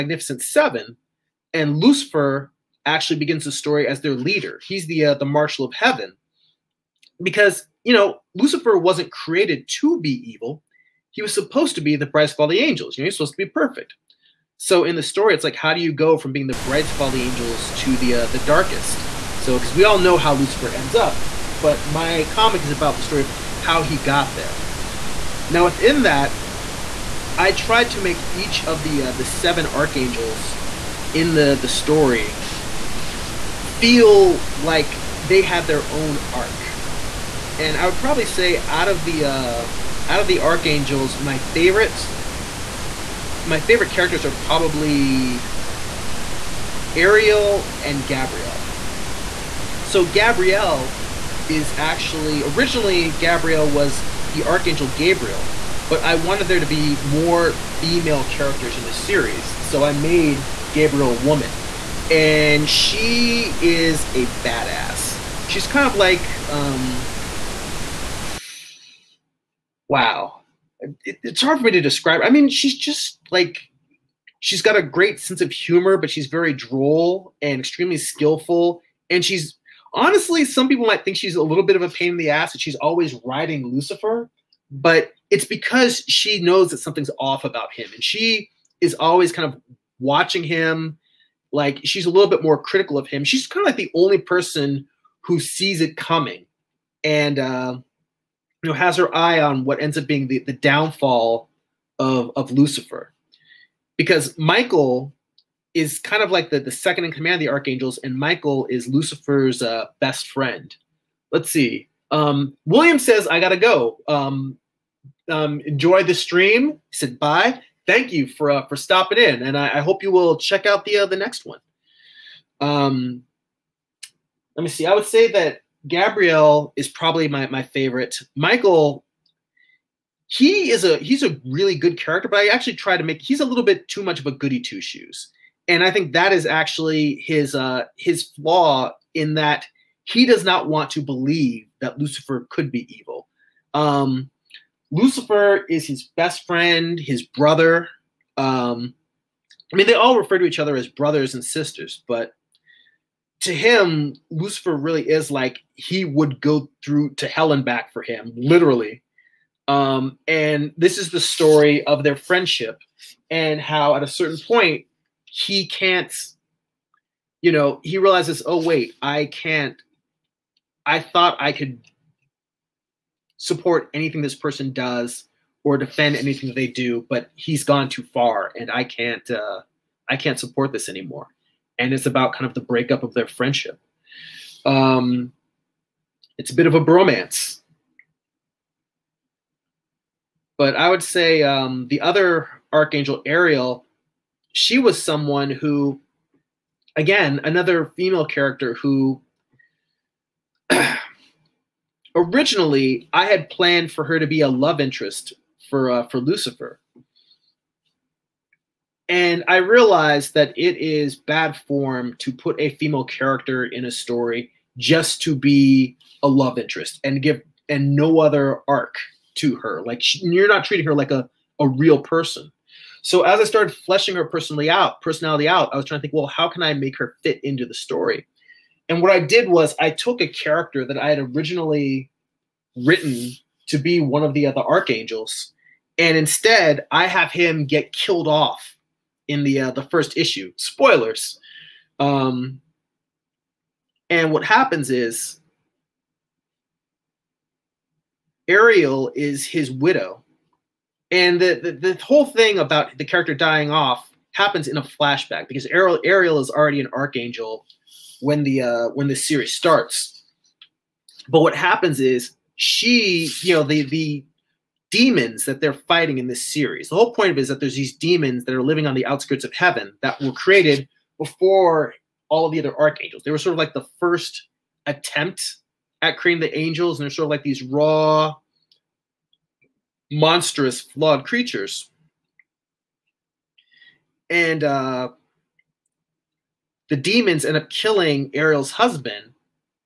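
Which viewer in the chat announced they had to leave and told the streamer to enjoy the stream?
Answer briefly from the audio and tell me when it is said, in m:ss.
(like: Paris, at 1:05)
William, at 1:52.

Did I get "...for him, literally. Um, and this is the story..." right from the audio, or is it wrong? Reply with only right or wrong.
right.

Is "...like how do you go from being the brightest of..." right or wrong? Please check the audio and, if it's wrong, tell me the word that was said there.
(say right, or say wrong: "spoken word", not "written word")
right.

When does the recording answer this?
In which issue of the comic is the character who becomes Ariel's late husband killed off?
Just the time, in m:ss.
3:59.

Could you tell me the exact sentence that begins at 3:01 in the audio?
And it's about kind of the breakup of their friendship.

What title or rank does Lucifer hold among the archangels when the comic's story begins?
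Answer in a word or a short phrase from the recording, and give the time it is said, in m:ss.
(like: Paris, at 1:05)
Marshal of heaven, at 0:05.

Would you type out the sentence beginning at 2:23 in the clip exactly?
Um, Lucifer is his best friend, his brother.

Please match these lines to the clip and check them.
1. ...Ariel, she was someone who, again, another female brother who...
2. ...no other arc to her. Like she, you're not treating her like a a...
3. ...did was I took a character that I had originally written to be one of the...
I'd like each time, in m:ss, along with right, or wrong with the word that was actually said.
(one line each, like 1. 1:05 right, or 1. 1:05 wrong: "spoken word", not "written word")
1. 3:13 wrong: "character", not "brother"
2. 3:37 right
3. 3:49 right.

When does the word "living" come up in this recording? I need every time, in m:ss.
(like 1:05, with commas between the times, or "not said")
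4:28.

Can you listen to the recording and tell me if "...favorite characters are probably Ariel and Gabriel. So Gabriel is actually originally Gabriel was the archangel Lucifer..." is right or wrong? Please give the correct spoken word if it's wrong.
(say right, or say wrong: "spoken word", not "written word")
wrong: "Gabriel", not "Lucifer".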